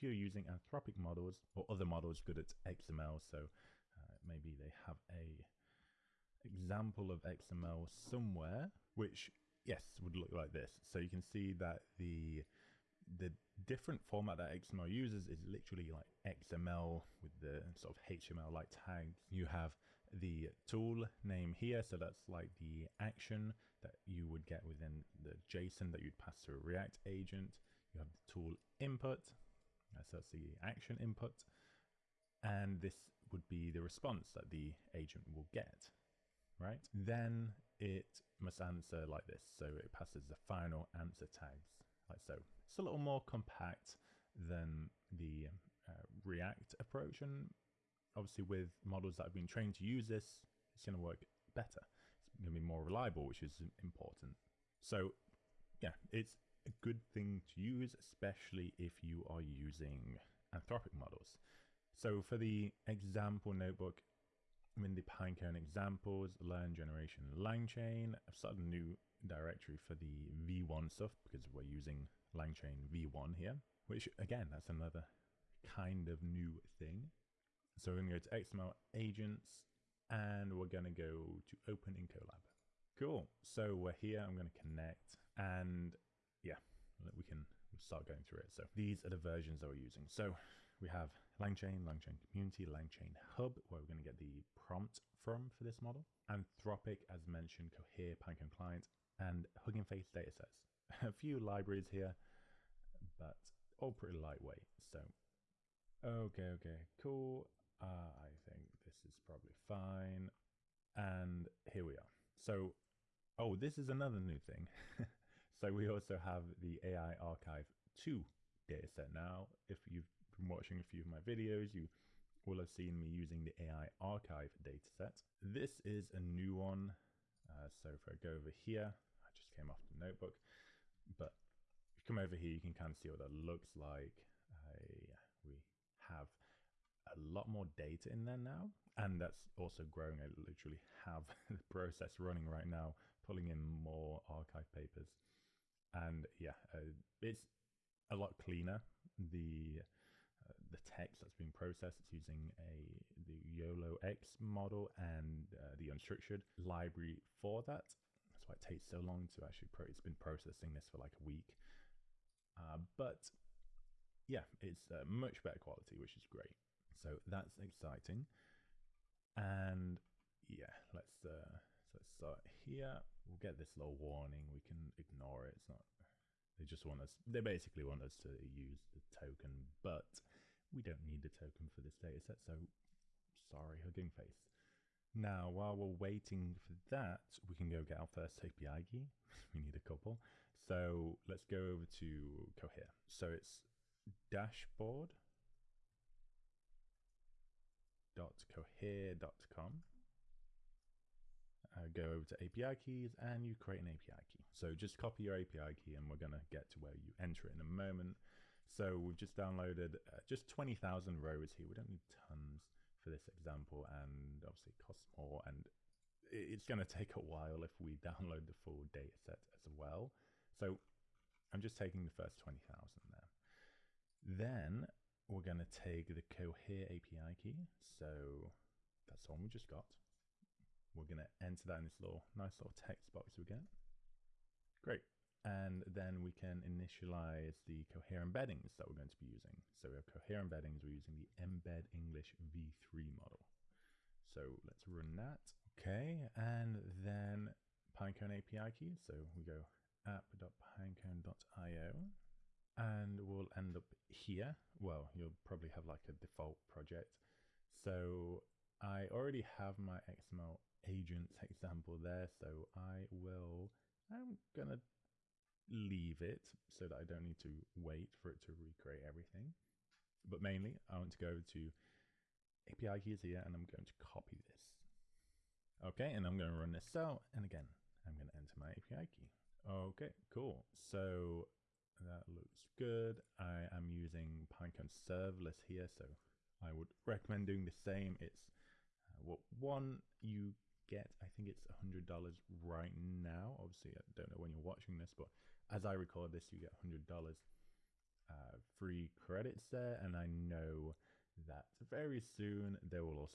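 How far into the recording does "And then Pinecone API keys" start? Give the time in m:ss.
4:06.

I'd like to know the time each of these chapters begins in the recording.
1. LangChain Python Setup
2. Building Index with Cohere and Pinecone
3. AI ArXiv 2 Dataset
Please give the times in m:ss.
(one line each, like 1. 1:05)
1. 1:22
2. 3:43
3. 1:52.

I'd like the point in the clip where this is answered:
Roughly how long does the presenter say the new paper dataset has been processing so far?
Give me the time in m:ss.
2:41.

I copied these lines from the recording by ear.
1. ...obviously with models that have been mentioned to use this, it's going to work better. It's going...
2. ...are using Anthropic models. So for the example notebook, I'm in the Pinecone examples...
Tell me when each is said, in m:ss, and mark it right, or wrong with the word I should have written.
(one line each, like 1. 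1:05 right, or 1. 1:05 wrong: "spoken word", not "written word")
1. 0:48 wrong: "trained", not "mentioned"
2. 0:59 right.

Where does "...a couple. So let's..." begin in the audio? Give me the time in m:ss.
3:09.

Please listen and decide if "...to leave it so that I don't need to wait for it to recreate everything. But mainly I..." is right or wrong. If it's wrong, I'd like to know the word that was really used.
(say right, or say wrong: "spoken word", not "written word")
right.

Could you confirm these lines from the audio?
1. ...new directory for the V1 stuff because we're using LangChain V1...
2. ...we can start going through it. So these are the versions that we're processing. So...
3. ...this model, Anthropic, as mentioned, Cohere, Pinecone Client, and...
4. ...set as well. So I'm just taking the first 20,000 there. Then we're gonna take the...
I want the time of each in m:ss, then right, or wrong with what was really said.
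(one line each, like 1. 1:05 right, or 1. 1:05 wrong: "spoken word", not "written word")
1. 1:08 right
2. 1:27 wrong: "using", not "processing"
3. 1:35 right
4. 3:39 right.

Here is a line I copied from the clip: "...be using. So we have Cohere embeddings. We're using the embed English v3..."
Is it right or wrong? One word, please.
right.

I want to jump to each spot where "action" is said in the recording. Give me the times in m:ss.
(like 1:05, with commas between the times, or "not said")
0:22, 0:30.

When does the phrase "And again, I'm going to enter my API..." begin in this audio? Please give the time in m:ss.
4:37.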